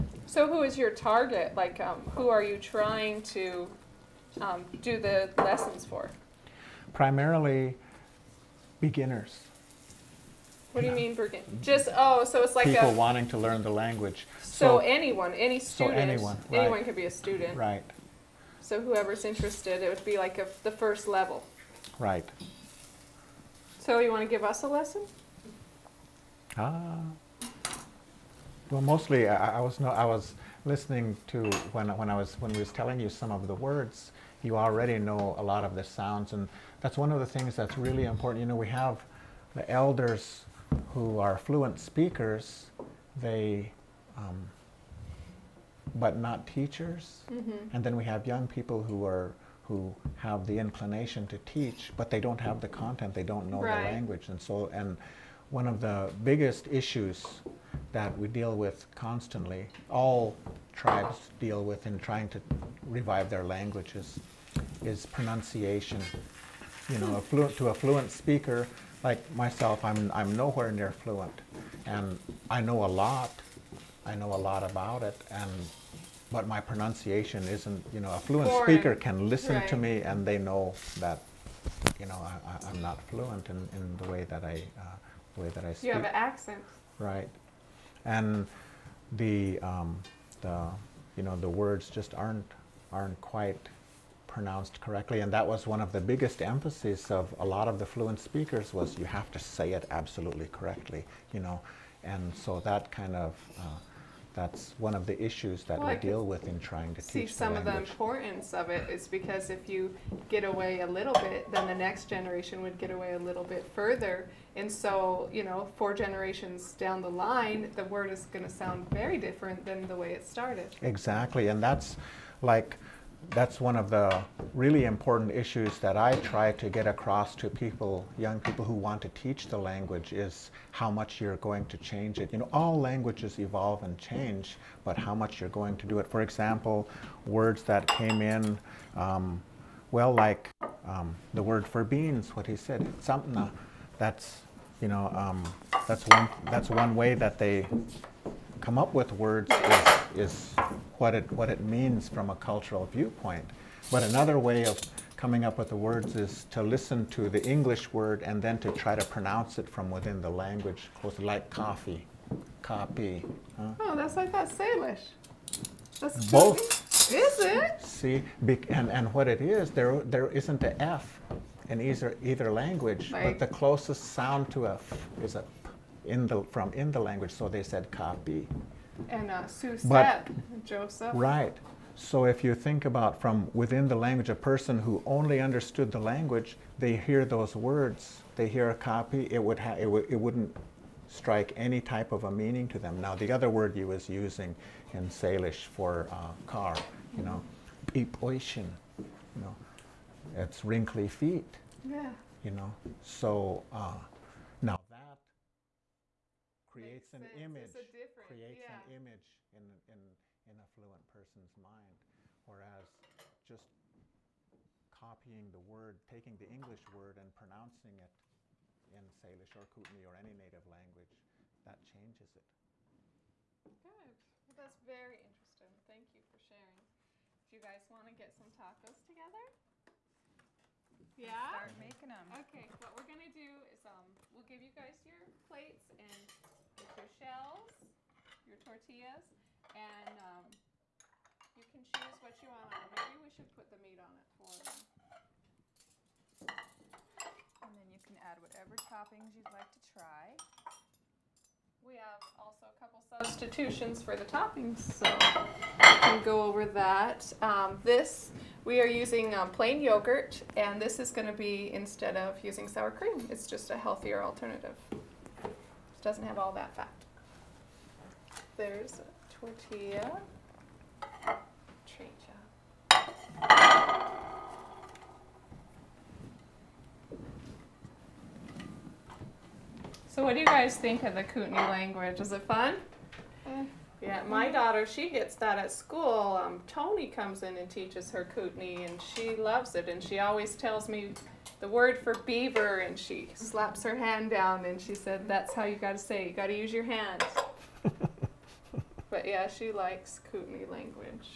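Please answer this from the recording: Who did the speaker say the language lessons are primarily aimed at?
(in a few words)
Beginners.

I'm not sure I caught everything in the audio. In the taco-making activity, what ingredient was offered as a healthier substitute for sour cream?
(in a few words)
Plain yogurt.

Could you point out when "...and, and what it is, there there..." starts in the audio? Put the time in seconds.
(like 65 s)
168 s.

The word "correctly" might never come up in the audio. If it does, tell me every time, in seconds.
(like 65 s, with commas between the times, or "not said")
94 s, 100 s.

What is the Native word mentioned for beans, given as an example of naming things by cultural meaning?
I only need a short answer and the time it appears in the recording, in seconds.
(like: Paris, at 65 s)
Samna, at 143 s.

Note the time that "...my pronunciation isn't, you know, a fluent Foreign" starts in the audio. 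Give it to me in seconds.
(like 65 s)
76 s.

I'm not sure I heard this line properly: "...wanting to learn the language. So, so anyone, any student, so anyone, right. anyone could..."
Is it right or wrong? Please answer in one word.
right.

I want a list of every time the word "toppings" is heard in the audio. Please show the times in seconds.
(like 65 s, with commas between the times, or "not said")
248 s, 254 s.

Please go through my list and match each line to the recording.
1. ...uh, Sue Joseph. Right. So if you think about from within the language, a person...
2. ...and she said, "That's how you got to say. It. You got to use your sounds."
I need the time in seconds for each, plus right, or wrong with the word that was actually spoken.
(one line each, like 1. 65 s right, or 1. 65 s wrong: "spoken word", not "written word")
1. 179 s right
2. 294 s wrong: "hands", not "sounds".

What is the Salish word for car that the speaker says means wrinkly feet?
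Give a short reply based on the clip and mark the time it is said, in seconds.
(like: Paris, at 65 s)
Pipoishin, at 198 s.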